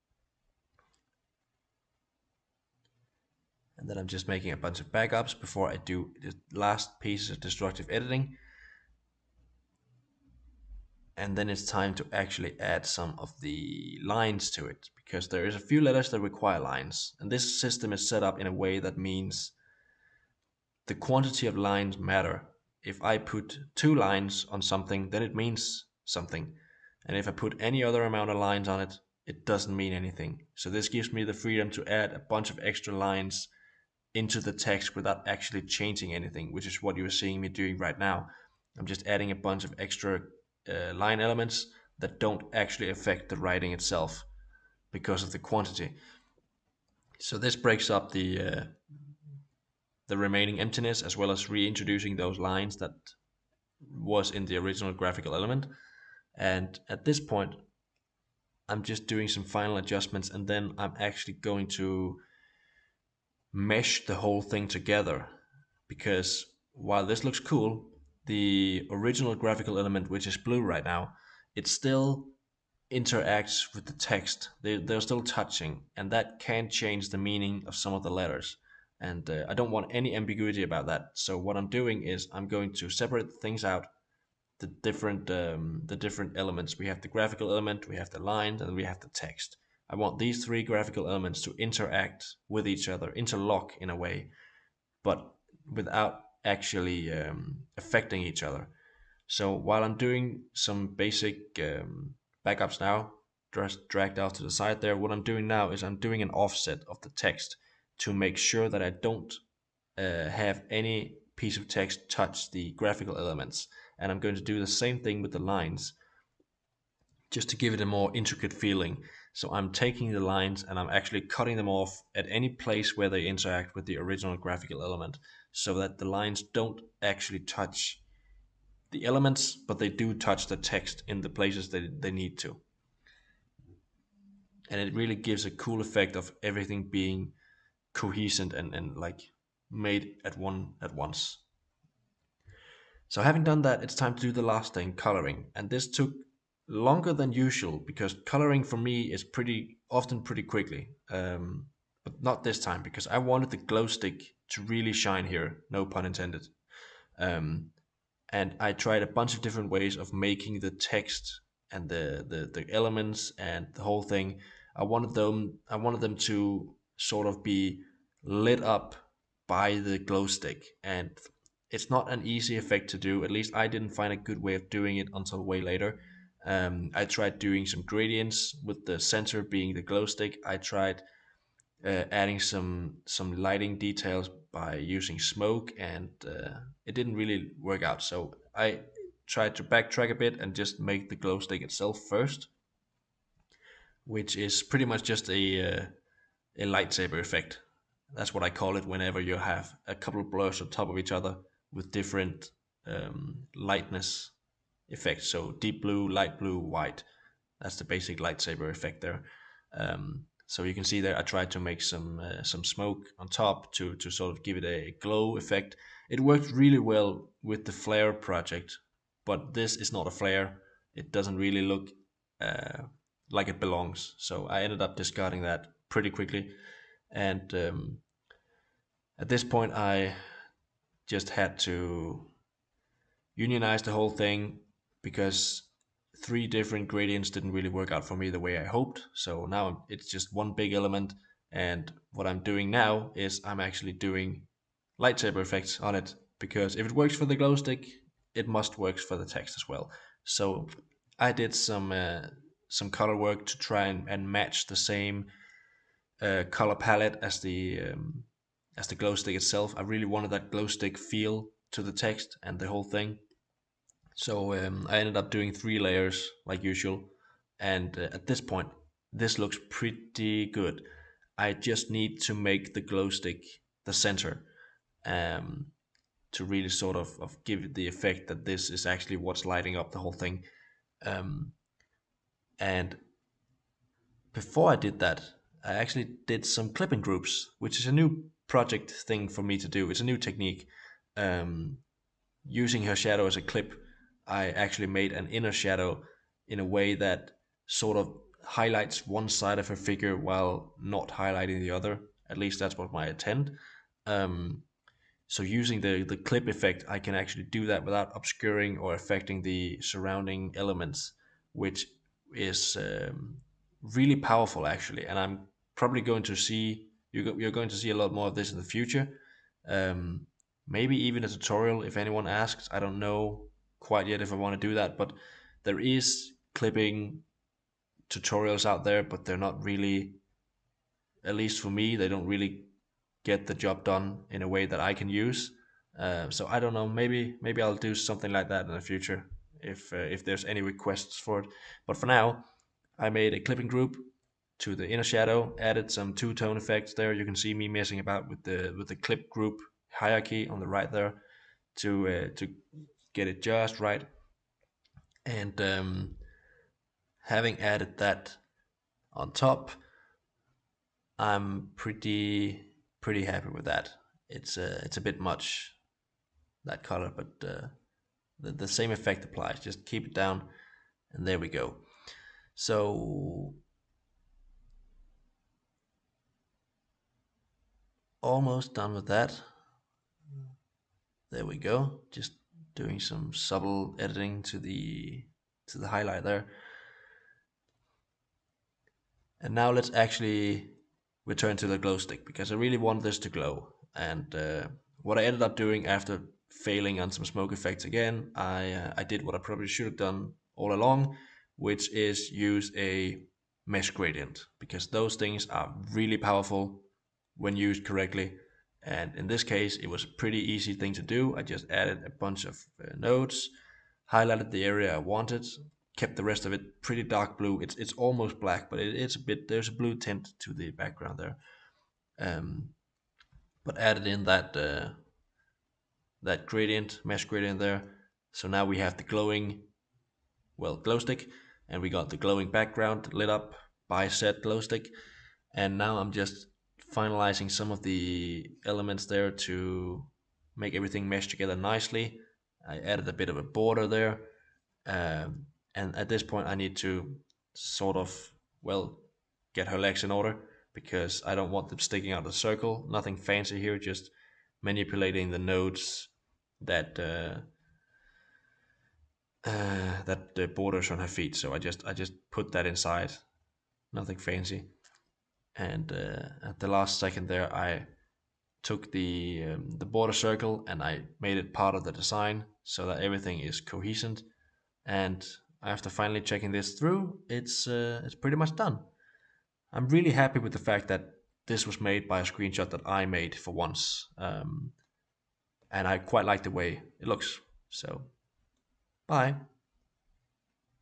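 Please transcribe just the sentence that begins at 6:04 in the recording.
It's a uh, it's a bit much that color, but uh, the, the same effect applies.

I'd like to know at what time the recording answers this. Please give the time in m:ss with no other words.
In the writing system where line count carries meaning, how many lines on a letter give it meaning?
0:23.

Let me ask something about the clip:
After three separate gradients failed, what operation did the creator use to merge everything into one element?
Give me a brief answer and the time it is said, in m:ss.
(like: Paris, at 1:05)
unionize, at 3:53.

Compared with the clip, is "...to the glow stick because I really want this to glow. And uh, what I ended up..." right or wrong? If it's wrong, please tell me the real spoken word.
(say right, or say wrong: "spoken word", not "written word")
right.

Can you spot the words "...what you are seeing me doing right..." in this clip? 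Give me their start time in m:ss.
0:36.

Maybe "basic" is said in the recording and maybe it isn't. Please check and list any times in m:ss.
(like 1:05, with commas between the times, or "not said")
1:40, 3:27.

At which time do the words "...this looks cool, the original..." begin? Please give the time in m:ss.
1:07.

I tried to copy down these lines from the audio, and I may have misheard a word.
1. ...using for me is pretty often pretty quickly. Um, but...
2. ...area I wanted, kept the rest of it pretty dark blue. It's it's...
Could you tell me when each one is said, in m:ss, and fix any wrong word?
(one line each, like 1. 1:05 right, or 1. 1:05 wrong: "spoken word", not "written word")
1. 2:28 wrong: "coloring", not "using"
2. 6:54 right.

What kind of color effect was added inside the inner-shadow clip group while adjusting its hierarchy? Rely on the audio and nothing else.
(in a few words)
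two-tone effects.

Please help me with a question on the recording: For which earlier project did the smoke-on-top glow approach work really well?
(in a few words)
the flare project.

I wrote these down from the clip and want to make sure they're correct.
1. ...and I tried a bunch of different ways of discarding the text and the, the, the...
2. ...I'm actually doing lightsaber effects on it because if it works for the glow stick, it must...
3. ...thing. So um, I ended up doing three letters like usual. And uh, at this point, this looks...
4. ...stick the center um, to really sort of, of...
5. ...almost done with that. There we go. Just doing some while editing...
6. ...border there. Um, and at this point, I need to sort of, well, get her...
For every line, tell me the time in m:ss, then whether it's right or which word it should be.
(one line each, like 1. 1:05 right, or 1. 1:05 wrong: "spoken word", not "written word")
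1. 2:38 wrong: "making", not "discarding"
2. 4:03 right
3. 4:22 wrong: "layers", not "letters"
4. 4:33 right
5. 6:18 wrong: "subtle", not "while"
6. 7:23 right.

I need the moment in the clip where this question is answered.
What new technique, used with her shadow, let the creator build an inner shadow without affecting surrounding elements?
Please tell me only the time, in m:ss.
4:46.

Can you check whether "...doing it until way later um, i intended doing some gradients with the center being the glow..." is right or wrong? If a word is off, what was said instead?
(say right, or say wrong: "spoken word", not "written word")
wrong: "tried", not "intended".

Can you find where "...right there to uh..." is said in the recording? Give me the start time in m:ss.
5:50.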